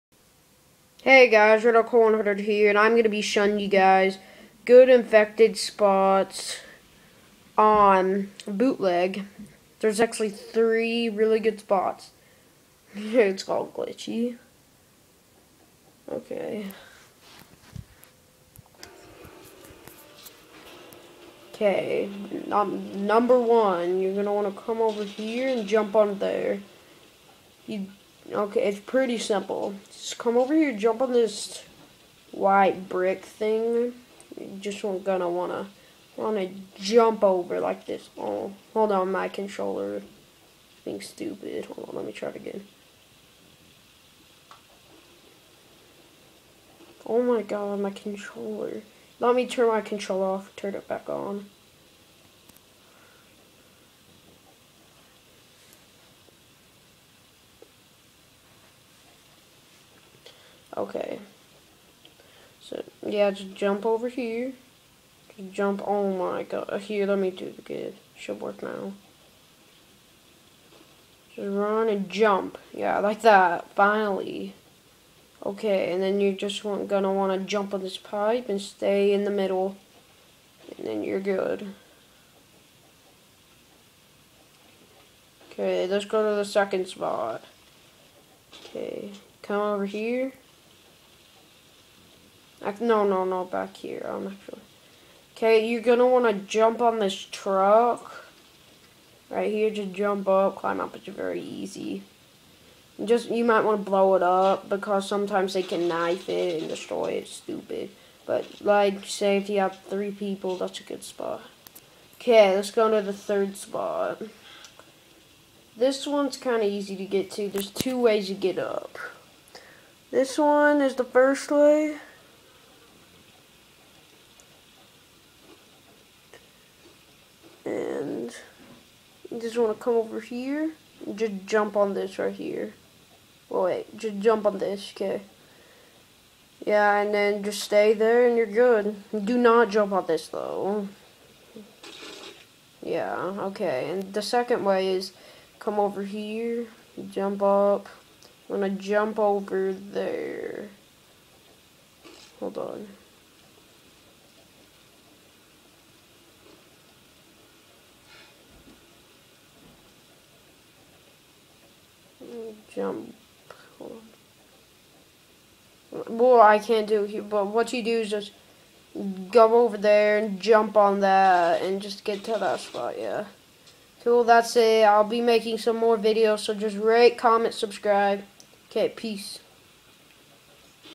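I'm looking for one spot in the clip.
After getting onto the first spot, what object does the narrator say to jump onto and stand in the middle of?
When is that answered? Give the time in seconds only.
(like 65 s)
77 s.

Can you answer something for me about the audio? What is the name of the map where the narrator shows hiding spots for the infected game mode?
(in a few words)
Bootleg.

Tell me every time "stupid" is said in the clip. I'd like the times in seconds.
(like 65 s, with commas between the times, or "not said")
41 s, 107 s.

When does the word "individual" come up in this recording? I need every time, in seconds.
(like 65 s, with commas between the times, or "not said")
not said.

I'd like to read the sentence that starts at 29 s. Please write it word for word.
Just come over here, jump on this white brick thing.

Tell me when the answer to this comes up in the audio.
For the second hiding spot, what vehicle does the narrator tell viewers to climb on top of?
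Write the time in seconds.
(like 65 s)
97 s.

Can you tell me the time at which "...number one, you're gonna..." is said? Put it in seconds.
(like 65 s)
23 s.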